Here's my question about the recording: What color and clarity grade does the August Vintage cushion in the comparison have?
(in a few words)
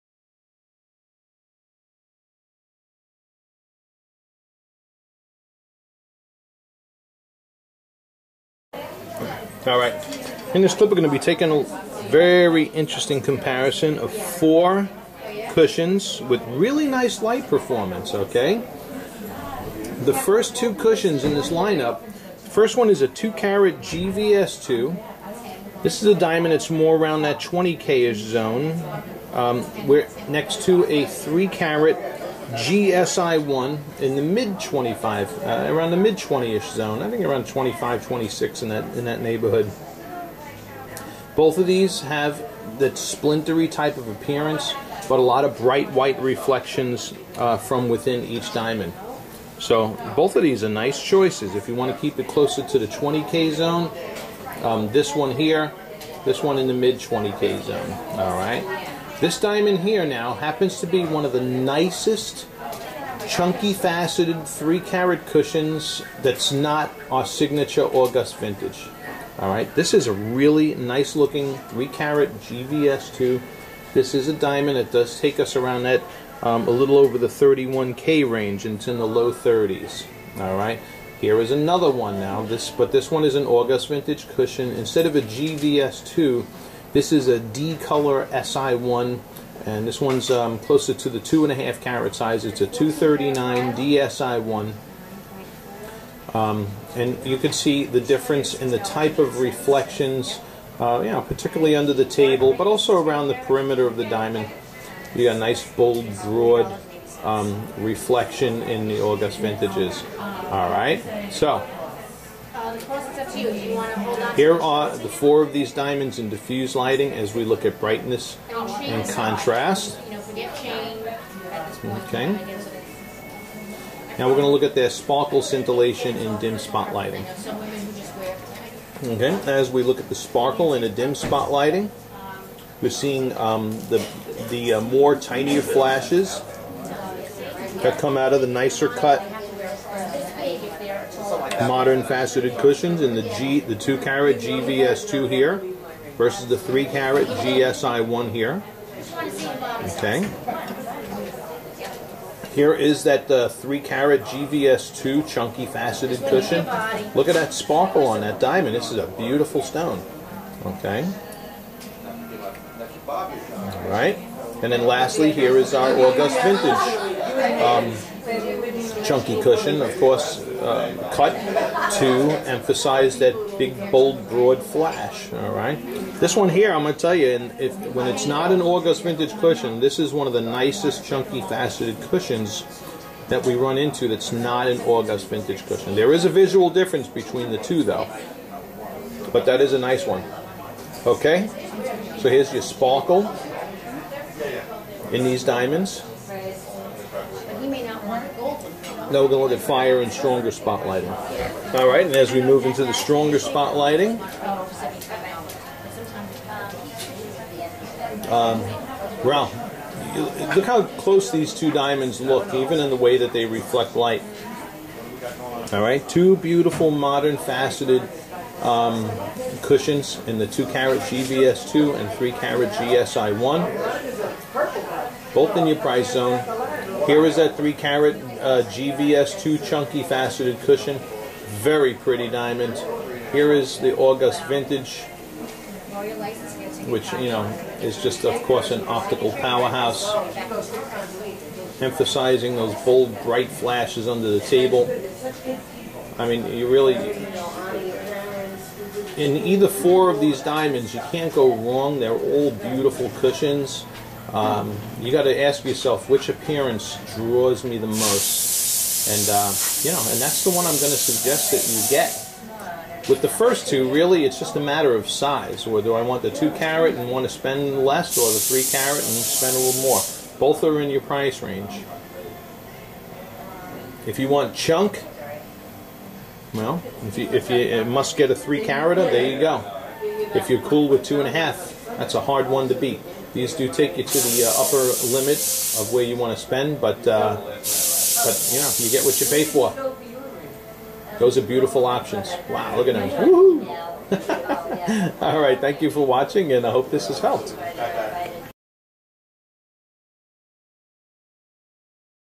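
D SI1.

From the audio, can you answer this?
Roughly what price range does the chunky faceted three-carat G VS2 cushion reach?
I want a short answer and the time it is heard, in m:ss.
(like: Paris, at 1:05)
low 30s (thousands), at 1:19.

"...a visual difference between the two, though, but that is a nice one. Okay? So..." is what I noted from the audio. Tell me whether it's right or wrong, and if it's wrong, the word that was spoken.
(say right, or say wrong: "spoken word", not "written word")
right.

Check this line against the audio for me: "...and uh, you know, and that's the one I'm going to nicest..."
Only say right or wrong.
wrong.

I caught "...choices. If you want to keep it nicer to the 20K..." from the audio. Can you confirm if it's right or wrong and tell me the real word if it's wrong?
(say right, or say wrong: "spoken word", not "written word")
wrong: "closer", not "nicer".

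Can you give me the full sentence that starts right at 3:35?
All right, two beautiful modern faceted um, cushions in the 2 carat GVS2 and 3 carat GSI1, both in your price zone.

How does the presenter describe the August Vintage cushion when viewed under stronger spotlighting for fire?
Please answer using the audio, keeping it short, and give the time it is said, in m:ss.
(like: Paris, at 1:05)
an optical powerhouse, at 3:58.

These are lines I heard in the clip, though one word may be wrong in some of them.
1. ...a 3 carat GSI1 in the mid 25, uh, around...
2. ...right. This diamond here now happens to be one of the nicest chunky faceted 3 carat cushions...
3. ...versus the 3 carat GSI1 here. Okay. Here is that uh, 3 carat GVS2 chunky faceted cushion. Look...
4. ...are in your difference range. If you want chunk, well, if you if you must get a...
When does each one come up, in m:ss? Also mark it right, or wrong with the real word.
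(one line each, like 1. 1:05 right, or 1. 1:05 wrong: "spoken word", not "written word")
1. 0:30 right
2. 0:58 right
3. 2:26 right
4. 4:30 wrong: "price", not "difference".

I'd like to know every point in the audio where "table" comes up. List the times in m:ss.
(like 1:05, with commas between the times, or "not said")
1:42, 4:04.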